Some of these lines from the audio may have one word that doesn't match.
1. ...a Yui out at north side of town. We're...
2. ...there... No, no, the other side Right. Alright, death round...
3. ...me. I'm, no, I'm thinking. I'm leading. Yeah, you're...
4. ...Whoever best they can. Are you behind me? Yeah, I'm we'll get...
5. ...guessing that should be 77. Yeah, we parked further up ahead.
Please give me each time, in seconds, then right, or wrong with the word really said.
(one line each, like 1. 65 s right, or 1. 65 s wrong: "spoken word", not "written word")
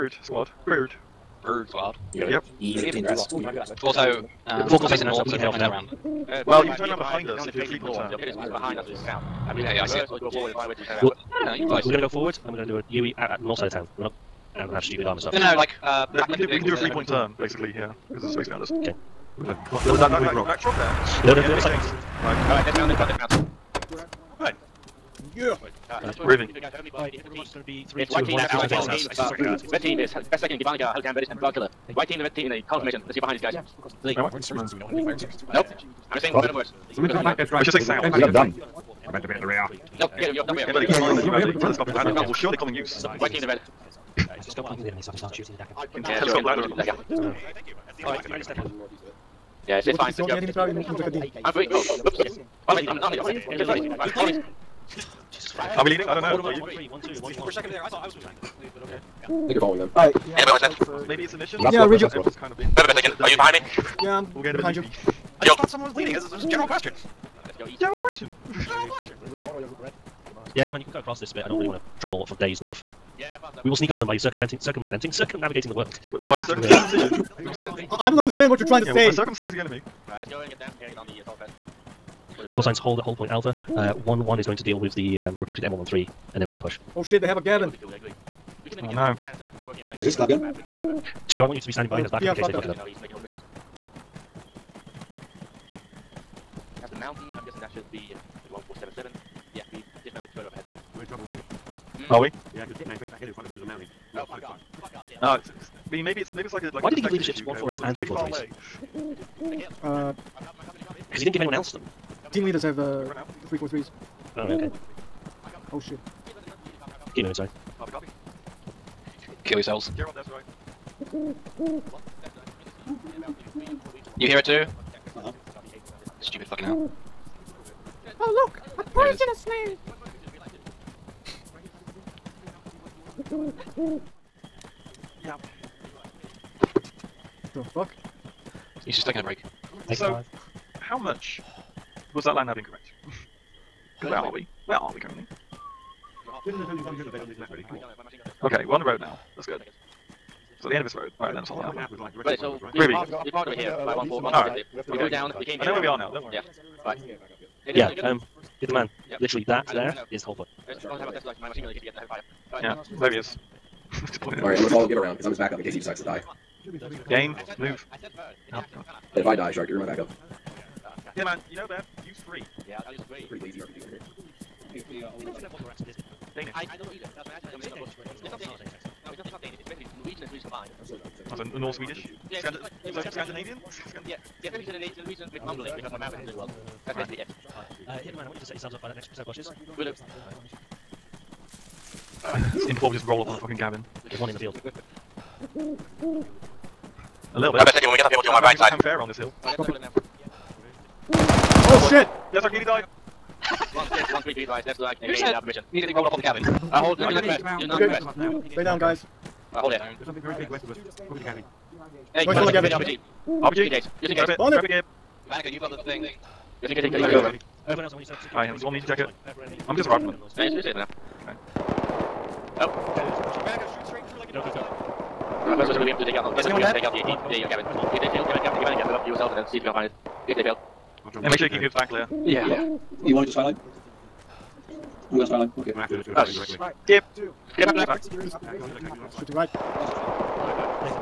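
1. 12 s right
2. 20 s right
3. 52 s wrong: "leading", not "thinking"
4. 62 s right
5. 97 s wrong: "dismounted", not "parked".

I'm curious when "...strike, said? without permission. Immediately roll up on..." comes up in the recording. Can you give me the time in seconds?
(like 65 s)
204 s.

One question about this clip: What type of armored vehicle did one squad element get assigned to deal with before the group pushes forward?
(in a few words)
M113.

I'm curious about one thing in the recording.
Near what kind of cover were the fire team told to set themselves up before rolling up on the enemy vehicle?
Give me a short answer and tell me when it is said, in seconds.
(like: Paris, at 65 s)
next set of bushes, at 188 s.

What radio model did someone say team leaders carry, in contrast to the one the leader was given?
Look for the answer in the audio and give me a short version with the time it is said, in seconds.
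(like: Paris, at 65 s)
343s, at 113 s.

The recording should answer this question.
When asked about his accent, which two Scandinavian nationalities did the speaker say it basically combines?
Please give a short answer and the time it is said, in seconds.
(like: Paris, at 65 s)
Norwegian and Swedish, at 179 s.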